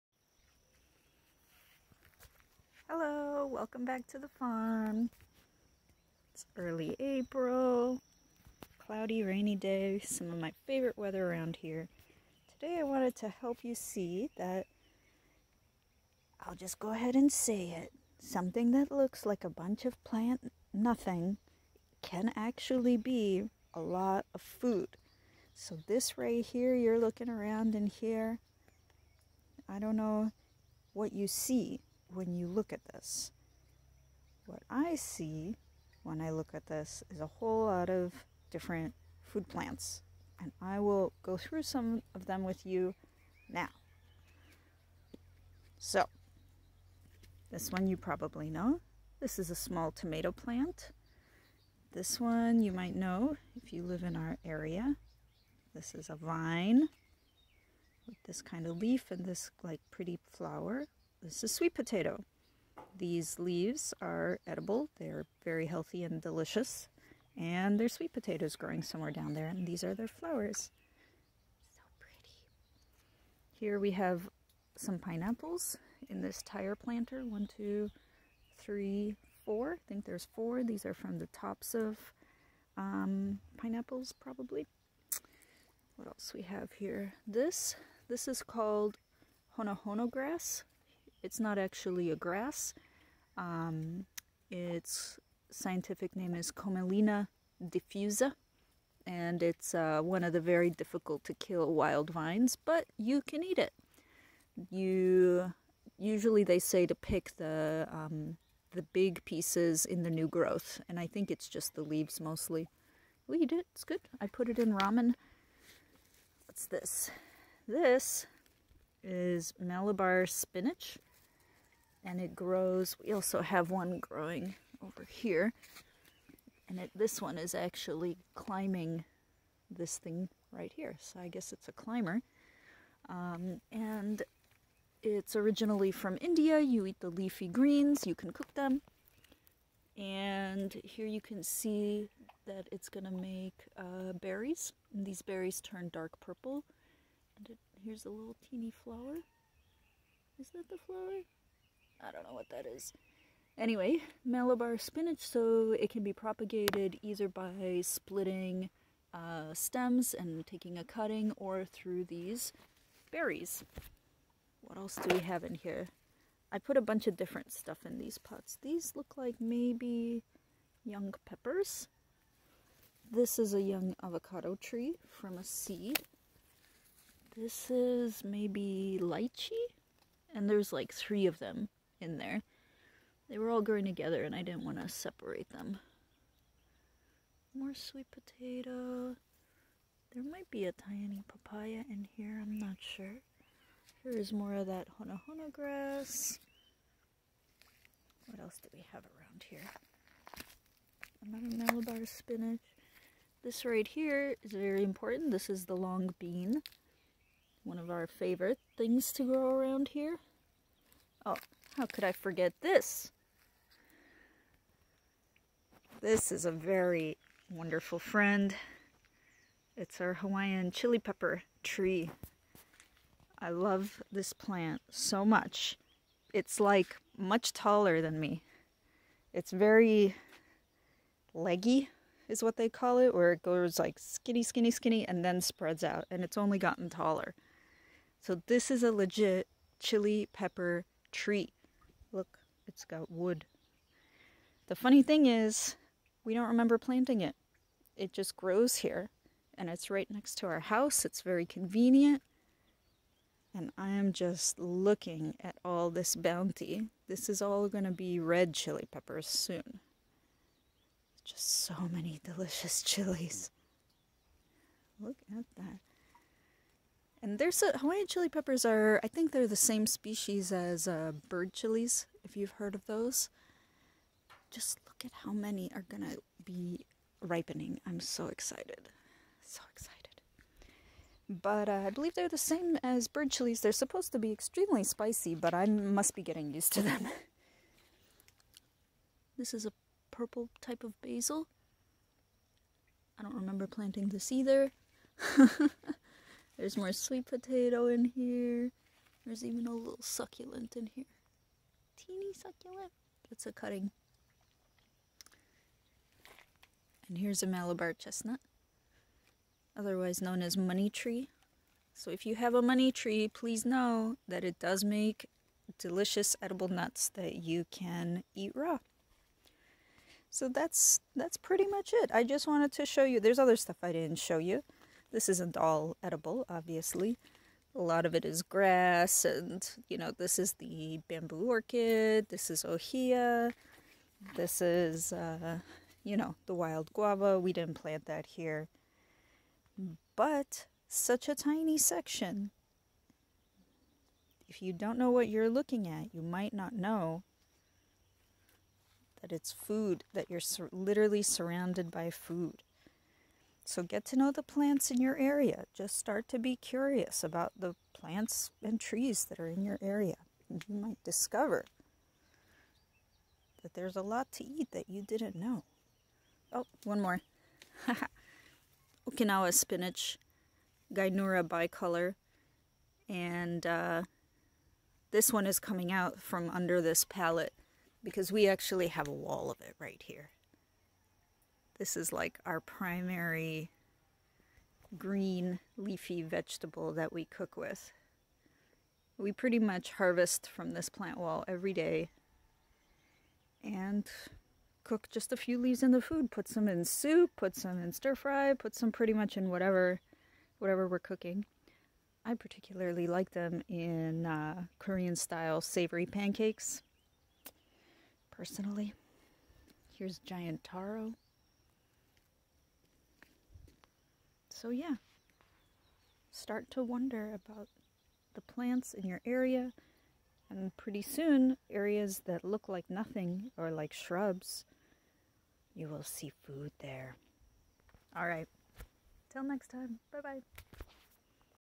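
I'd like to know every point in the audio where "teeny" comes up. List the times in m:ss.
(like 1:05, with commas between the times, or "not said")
2:28, 5:01.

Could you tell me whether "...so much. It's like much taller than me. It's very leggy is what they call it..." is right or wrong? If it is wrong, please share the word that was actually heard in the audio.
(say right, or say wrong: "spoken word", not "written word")
right.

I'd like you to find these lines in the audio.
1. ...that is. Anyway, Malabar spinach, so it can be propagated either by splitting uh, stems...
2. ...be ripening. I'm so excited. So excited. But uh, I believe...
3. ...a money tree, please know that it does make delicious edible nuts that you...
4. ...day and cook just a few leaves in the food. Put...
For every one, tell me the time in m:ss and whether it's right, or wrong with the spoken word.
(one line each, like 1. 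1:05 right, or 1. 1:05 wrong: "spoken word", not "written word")
1. 2:32 right
2. 4:36 right
3. 5:12 right
4. 6:31 right.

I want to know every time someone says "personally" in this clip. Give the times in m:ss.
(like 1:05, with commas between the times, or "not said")
6:48.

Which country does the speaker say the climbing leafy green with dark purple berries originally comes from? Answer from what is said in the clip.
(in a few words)
India.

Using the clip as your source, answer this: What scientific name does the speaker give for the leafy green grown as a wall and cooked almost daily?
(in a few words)
Gynura bicolor.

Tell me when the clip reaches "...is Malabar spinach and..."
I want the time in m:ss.
1:59.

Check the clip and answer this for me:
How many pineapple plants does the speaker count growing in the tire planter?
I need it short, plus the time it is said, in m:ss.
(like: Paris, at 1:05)
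4, at 1:19.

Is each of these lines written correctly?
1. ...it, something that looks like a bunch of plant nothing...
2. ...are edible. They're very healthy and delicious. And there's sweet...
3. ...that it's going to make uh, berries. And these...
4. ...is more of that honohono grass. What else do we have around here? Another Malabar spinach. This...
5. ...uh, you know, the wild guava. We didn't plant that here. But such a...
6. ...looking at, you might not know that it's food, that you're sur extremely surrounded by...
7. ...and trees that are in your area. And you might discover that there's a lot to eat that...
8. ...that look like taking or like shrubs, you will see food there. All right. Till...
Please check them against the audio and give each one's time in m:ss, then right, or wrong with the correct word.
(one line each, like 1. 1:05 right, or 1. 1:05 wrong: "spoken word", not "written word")
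1. 0:17 right
2. 1:04 right
3. 2:22 right
4. 3:14 right
5. 5:35 right
6. 5:45 wrong: "literally", not "extremely"
7. 5:58 right
8. 7:02 wrong: "nothing", not "taking".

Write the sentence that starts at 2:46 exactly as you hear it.
I put a bunch of different stuff in these pots.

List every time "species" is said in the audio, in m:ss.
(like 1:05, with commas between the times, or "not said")
4:29.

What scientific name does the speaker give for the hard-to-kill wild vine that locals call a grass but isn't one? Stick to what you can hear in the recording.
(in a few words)
Commelina diffusa.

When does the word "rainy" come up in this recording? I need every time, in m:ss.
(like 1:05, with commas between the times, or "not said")
0:09.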